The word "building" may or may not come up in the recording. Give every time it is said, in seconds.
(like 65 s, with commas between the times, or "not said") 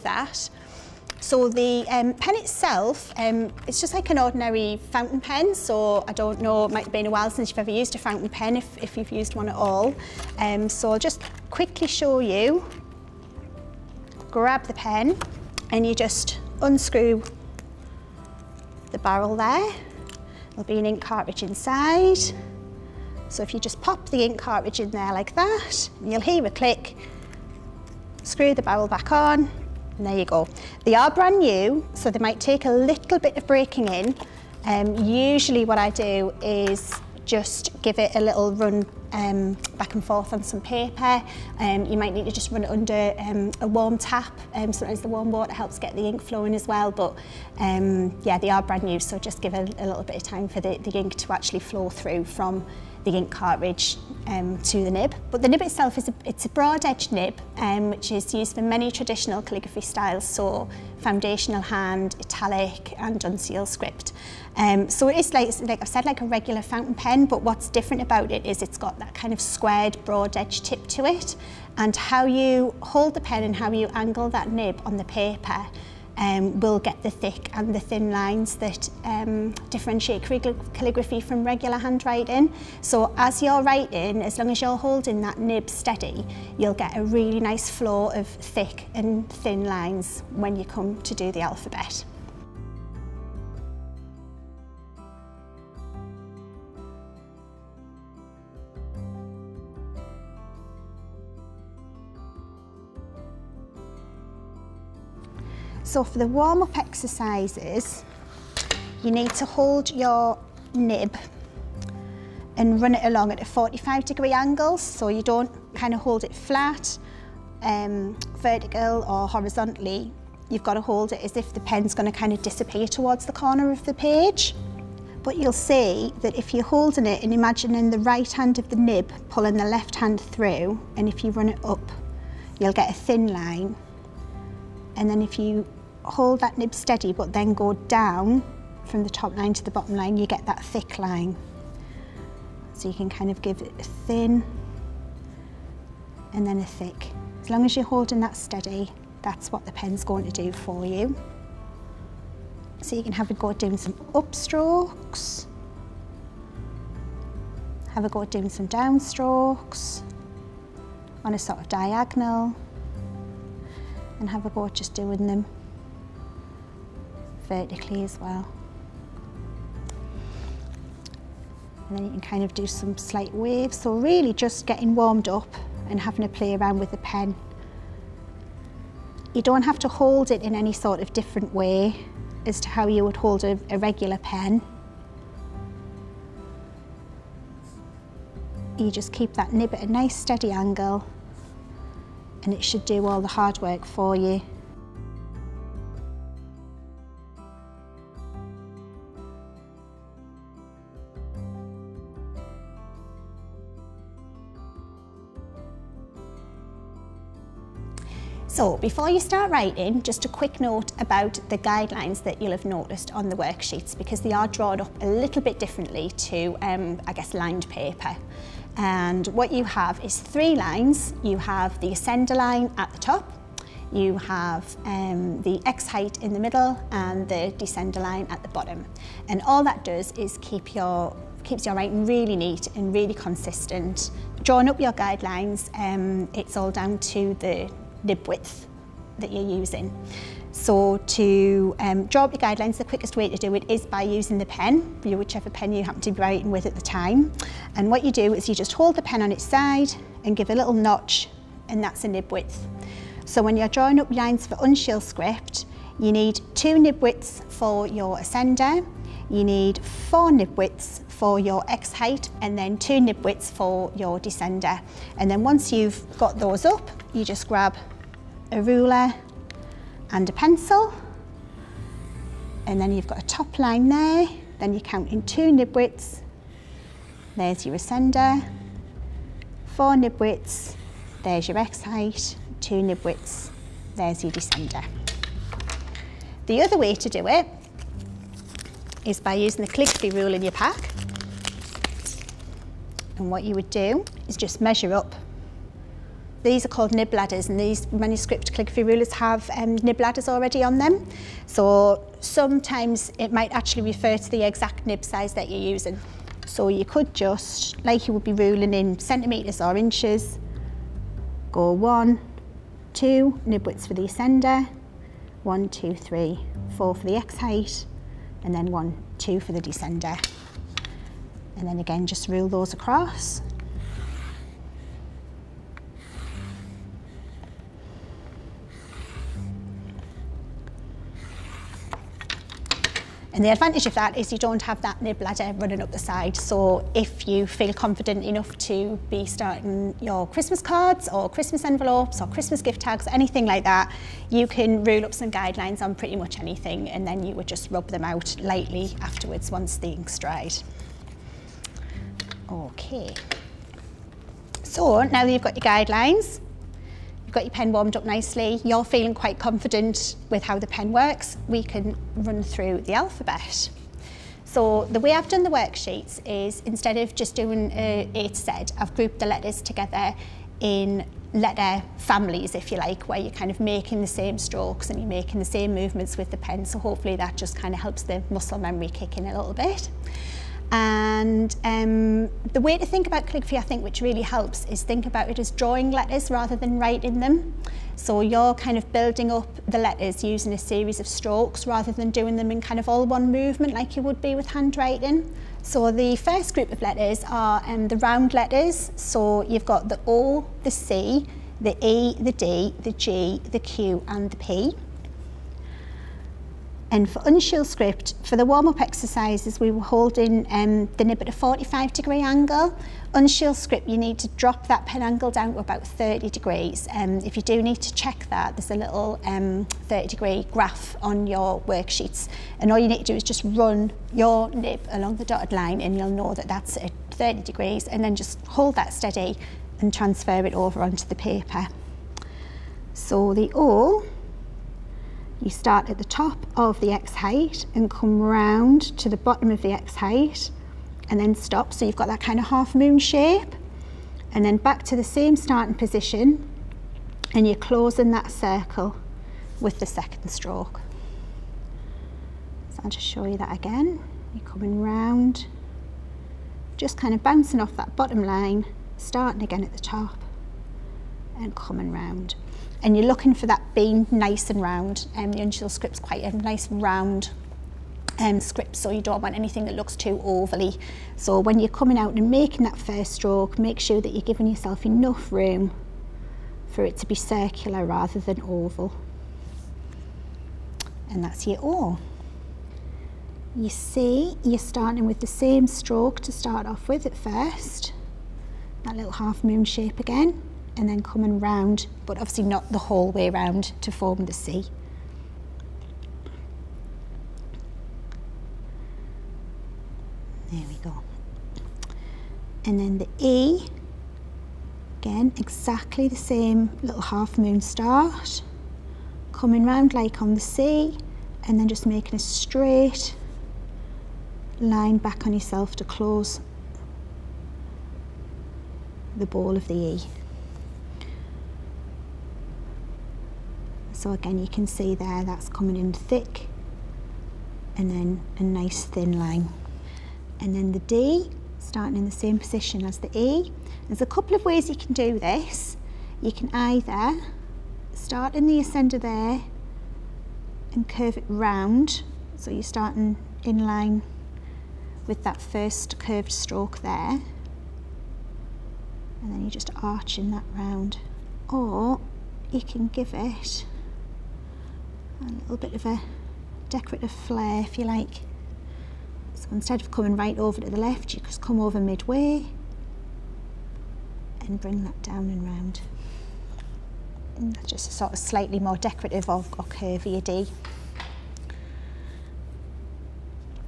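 388 s.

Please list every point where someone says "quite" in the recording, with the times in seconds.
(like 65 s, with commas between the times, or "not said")
359 s, 465 s.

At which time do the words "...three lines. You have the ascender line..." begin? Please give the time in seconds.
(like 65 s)
220 s.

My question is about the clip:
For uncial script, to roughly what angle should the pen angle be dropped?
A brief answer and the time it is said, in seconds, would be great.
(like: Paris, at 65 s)
30 degrees, at 415 s.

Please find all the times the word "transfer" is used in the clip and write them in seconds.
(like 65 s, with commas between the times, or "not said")
429 s.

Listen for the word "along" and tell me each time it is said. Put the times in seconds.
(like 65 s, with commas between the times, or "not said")
113 s, 424 s.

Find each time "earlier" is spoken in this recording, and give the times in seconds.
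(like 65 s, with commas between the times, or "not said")
not said.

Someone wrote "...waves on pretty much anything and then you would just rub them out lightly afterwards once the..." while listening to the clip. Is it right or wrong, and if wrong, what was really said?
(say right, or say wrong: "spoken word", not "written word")
wrong: "guidelines", not "waves".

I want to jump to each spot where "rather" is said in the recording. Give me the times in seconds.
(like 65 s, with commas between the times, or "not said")
386 s, 391 s, 477 s.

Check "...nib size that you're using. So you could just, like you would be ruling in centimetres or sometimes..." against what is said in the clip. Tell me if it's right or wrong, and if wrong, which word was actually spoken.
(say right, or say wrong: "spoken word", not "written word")
wrong: "inches", not "sometimes".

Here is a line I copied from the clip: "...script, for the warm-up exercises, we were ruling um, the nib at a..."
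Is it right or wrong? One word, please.
wrong.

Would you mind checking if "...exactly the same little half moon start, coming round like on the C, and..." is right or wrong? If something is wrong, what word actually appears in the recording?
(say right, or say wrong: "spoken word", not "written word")
right.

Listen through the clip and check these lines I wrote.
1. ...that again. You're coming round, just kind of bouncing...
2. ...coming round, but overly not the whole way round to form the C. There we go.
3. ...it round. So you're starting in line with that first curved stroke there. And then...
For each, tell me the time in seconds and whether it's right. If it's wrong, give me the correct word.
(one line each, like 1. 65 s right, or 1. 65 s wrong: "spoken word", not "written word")
1. 453 s right
2. 491 s wrong: "obviously", not "overly"
3. 541 s right.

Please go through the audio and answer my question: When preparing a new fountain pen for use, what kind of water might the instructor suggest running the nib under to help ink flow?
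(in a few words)
warm tap.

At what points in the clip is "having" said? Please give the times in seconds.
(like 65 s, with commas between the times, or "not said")
175 s.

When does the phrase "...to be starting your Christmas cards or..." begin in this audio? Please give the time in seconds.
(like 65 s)
338 s.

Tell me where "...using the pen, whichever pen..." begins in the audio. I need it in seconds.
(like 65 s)
244 s.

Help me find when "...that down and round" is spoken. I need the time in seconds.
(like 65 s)
564 s.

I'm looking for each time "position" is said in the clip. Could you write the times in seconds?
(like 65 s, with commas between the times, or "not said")
445 s, 532 s.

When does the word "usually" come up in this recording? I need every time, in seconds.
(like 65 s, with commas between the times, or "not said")
35 s.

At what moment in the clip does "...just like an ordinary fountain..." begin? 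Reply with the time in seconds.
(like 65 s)
3 s.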